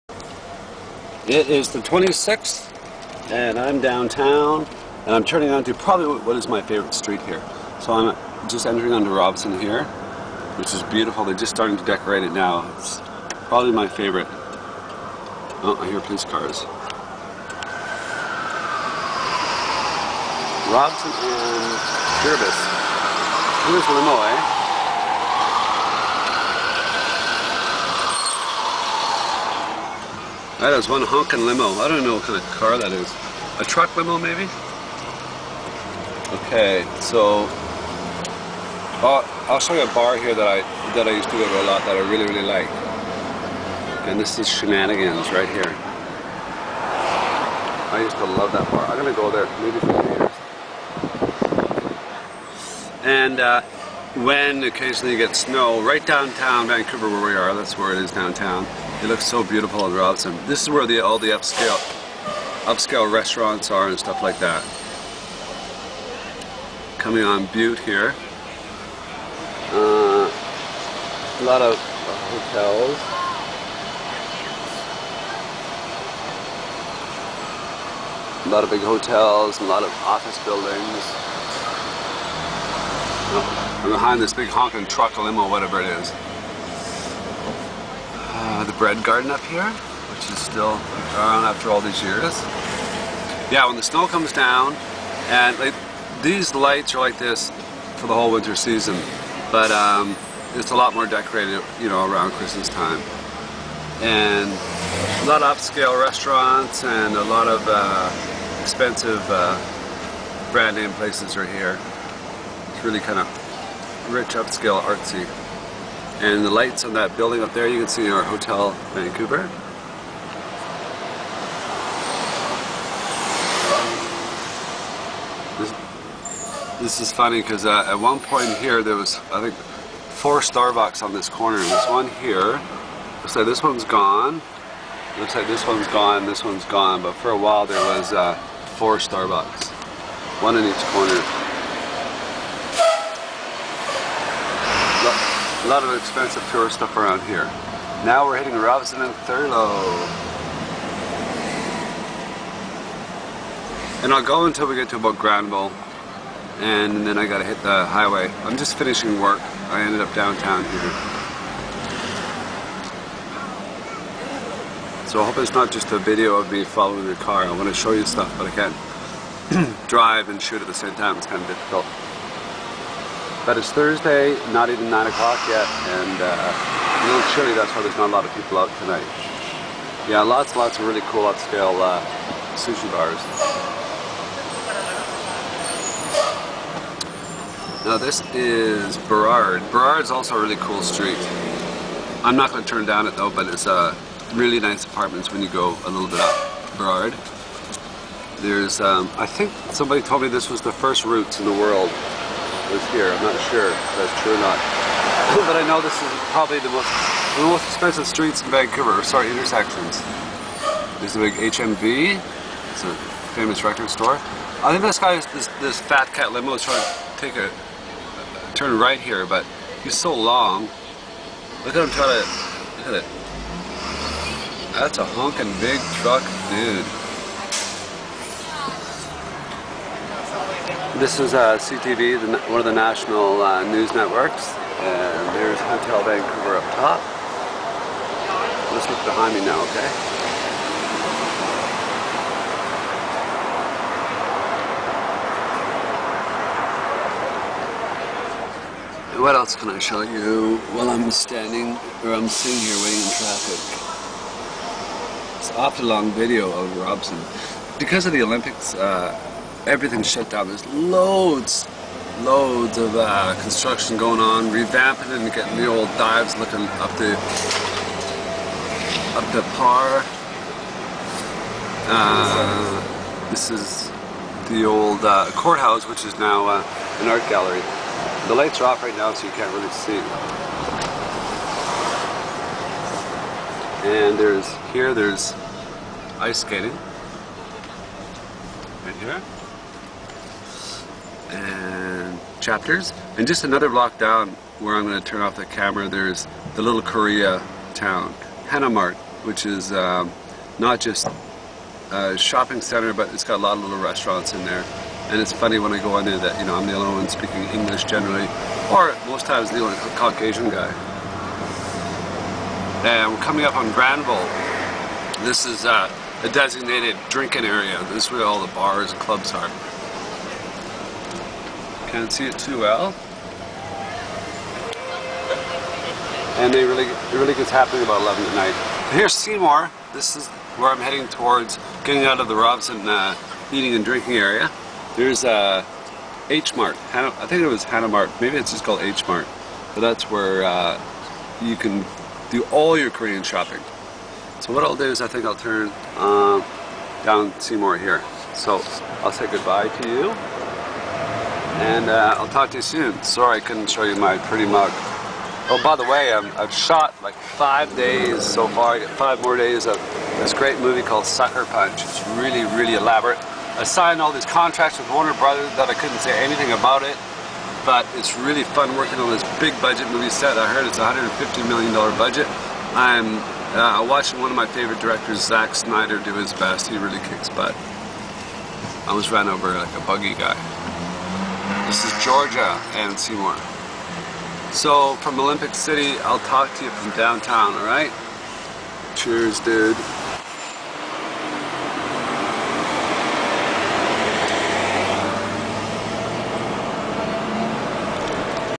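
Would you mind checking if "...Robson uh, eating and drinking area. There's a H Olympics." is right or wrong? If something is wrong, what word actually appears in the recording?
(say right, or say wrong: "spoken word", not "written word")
wrong: "Mart", not "Olympics".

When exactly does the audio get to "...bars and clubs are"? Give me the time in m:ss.
5:18.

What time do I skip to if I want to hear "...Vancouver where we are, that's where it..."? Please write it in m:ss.
0:56.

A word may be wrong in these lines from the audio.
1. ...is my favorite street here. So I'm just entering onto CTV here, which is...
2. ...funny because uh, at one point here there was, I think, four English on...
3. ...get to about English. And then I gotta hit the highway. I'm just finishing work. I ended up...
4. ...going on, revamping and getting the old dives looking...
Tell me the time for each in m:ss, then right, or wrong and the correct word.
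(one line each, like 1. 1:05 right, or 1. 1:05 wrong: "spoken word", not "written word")
1. 0:06 wrong: "Robson", not "CTV"
2. 2:07 wrong: "Starbucks", not "English"
3. 2:34 wrong: "Granville", not "English"
4. 4:23 right.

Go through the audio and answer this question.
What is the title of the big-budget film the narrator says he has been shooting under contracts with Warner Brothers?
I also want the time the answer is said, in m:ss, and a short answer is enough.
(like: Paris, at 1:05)
Sucker Punch, at 6:01.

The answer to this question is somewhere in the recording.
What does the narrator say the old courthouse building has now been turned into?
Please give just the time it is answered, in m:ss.
4:37.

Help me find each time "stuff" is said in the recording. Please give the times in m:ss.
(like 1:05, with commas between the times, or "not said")
1:03, 2:26, 2:48.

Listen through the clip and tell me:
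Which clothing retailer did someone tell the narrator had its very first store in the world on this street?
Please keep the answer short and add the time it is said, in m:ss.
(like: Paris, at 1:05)
Roots, at 3:21.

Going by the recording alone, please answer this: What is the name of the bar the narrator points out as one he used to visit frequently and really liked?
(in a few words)
Shenanigans.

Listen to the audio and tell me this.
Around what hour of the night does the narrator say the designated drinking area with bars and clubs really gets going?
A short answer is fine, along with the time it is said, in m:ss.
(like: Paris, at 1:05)
11, at 5:28.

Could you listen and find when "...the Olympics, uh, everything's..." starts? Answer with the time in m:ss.
4:18.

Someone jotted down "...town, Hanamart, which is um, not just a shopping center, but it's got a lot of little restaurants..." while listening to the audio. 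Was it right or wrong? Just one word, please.
right.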